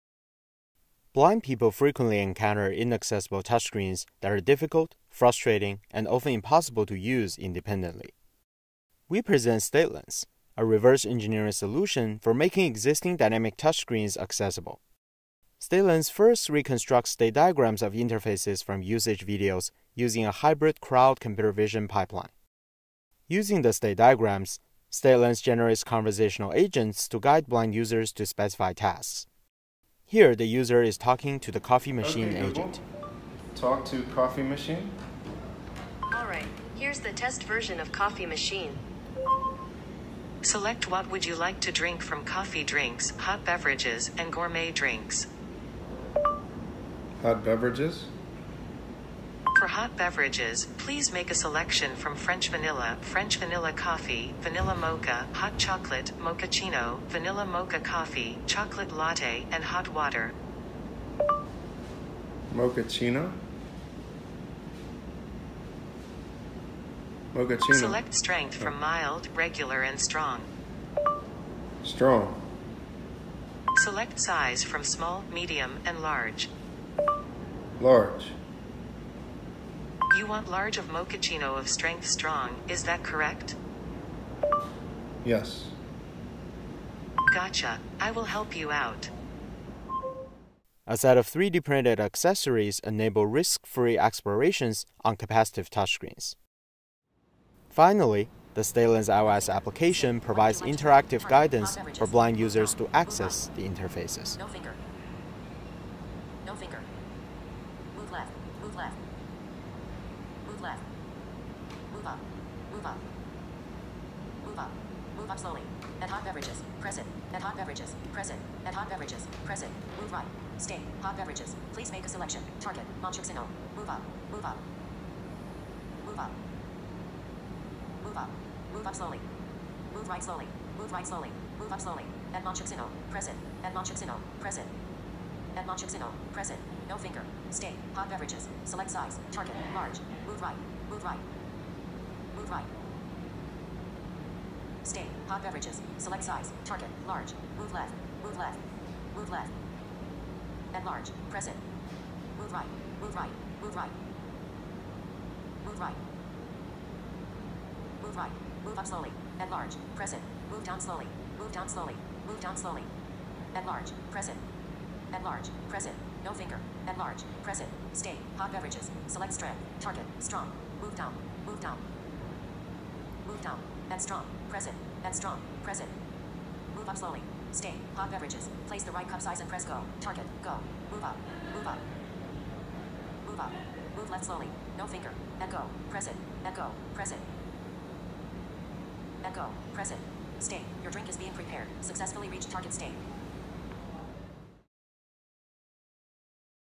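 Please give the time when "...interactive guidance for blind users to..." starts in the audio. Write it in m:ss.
1:40.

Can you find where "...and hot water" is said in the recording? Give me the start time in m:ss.
0:59.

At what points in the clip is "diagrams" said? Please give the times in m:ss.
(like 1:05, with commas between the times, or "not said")
0:17, 0:23.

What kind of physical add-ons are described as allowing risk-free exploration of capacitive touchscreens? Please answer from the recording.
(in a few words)
3D printed accessories.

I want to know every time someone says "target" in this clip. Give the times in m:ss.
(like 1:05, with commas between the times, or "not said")
2:02, 2:19, 2:26, 2:49, 2:59, 3:12.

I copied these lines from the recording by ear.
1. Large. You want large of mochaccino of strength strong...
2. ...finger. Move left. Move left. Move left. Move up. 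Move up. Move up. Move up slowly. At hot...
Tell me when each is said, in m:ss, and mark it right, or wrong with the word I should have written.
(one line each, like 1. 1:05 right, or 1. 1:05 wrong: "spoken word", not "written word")
1. 1:17 right
2. 1:46 right.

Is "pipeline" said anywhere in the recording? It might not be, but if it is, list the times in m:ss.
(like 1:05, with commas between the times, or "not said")
0:21.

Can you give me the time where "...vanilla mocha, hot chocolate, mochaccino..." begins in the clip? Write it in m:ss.
0:54.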